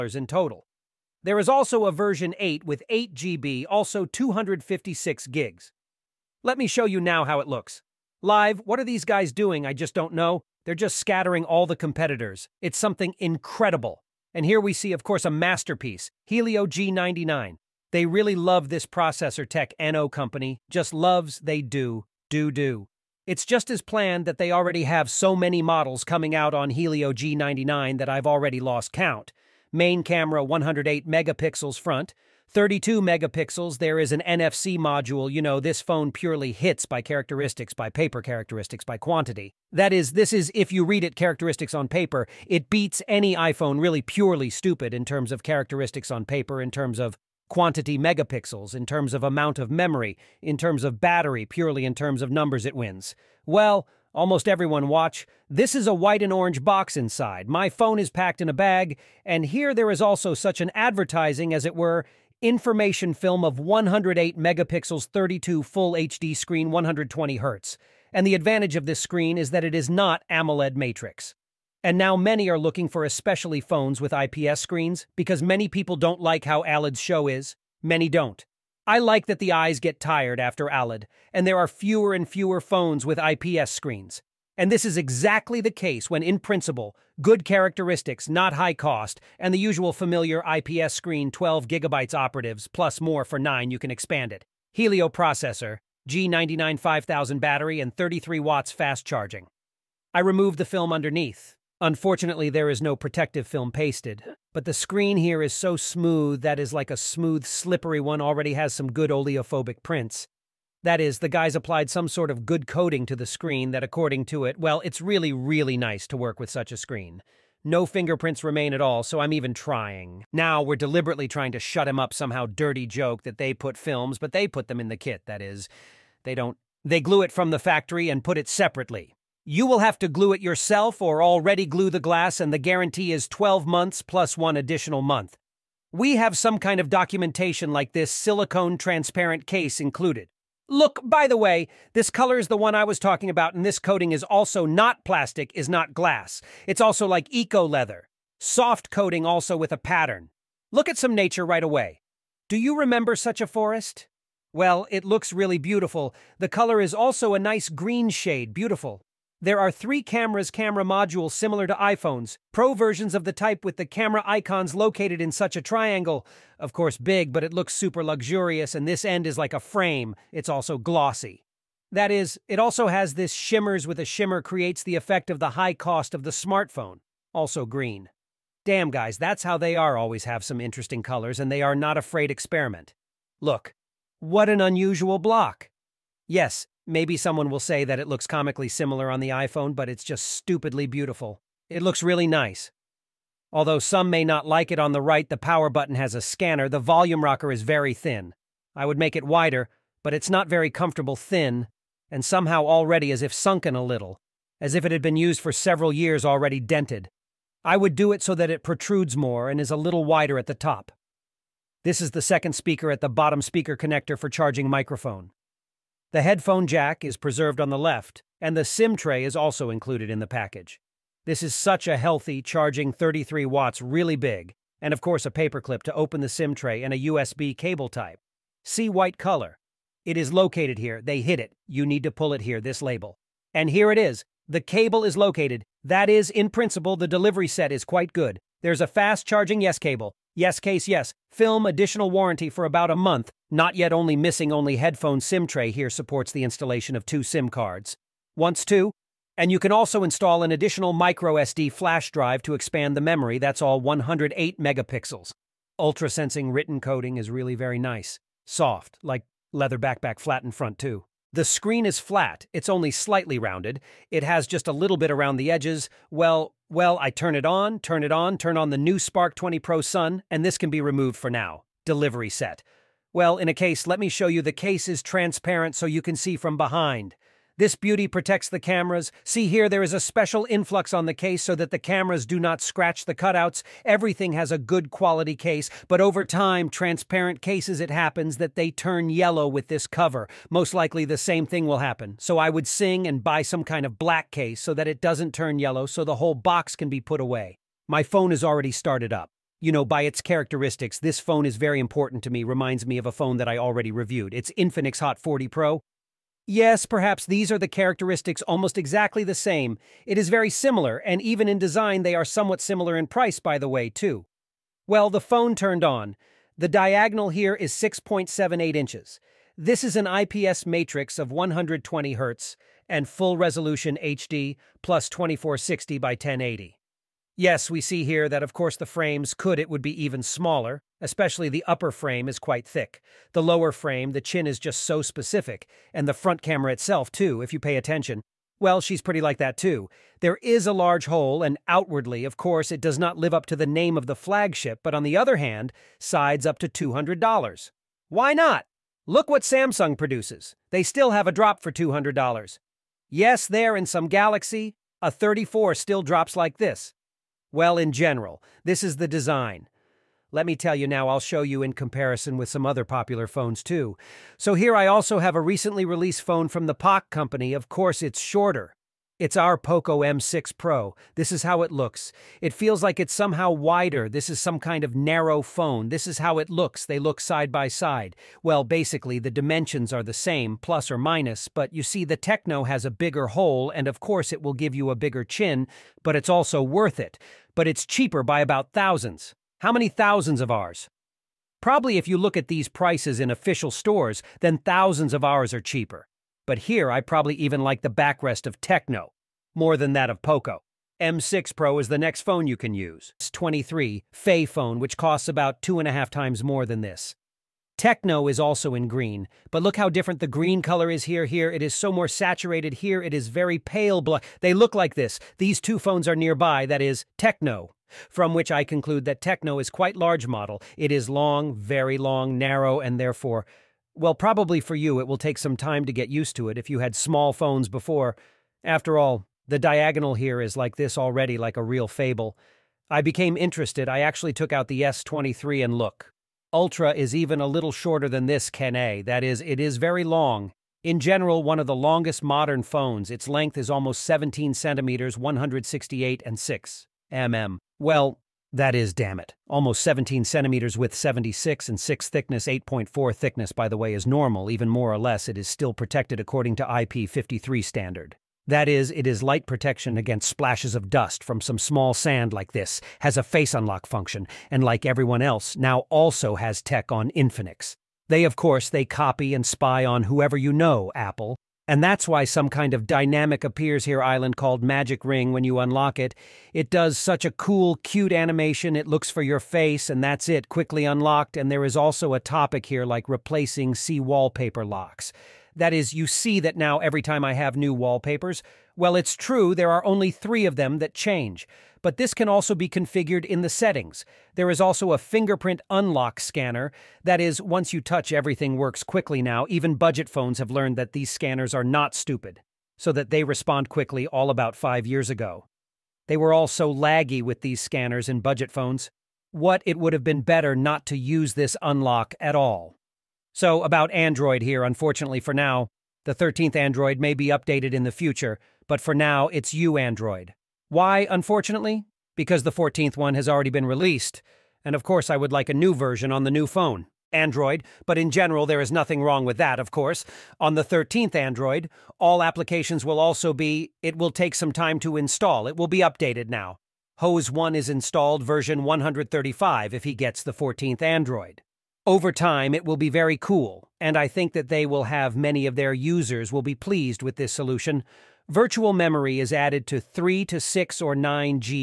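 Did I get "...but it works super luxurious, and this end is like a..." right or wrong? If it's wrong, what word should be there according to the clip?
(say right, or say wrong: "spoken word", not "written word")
wrong: "looks", not "works".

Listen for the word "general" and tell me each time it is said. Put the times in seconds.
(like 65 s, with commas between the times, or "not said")
357 s, 440 s, 528 s.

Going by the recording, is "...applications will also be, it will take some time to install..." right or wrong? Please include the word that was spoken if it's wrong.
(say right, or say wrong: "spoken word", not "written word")
right.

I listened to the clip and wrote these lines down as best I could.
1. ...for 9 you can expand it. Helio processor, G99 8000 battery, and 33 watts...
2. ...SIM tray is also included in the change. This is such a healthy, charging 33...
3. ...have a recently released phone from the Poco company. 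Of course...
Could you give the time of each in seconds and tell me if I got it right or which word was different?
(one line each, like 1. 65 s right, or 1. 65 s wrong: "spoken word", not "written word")
1. 93 s wrong: "5000", not "8000"
2. 218 s wrong: "package", not "change"
3. 365 s right.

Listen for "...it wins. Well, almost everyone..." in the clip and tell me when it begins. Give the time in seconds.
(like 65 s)
52 s.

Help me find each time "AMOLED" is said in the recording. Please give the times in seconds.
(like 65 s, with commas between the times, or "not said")
70 s.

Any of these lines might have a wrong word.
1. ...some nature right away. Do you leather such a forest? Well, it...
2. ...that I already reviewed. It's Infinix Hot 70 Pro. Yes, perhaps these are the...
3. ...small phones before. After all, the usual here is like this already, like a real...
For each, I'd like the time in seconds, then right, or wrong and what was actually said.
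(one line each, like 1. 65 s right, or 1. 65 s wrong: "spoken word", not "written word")
1. 150 s wrong: "remember", not "leather"
2. 303 s wrong: "40", not "70"
3. 426 s wrong: "diagonal", not "usual".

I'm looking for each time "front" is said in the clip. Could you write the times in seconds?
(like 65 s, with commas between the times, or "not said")
31 s, 260 s, 336 s.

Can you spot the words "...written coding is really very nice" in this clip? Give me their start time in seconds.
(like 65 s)
256 s.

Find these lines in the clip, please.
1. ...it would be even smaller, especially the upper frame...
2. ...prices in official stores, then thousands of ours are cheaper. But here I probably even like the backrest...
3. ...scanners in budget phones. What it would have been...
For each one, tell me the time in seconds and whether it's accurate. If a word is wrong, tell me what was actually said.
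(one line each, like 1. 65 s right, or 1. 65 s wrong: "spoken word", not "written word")
1. 329 s right
2. 392 s right
3. 507 s right.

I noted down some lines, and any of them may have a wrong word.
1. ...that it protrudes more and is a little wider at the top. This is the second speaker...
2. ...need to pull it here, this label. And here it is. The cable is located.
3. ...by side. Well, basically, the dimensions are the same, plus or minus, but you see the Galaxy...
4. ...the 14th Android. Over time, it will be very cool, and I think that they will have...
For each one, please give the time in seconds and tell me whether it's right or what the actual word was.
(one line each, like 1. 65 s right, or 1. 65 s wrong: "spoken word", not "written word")
1. 208 s right
2. 231 s right
3. 377 s wrong: "Tecno", not "Galaxy"
4. 540 s right.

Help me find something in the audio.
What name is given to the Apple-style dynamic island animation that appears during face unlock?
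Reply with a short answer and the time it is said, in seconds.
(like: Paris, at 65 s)
Magic Ring, at 474 s.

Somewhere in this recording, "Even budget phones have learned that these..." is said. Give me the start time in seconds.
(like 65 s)
499 s.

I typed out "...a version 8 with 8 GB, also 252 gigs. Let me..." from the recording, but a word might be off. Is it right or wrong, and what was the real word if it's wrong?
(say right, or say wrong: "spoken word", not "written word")
wrong: "256", not "252".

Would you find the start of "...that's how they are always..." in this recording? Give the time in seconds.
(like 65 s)
179 s.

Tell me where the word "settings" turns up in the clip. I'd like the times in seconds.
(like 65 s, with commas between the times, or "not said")
493 s.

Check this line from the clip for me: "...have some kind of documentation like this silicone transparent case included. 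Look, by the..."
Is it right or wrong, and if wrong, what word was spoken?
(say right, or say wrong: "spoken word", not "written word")
right.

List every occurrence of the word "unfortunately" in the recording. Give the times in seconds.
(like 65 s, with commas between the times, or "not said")
101 s, 514 s, 521 s.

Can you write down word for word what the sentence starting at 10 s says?
They're just scattering all the competitors.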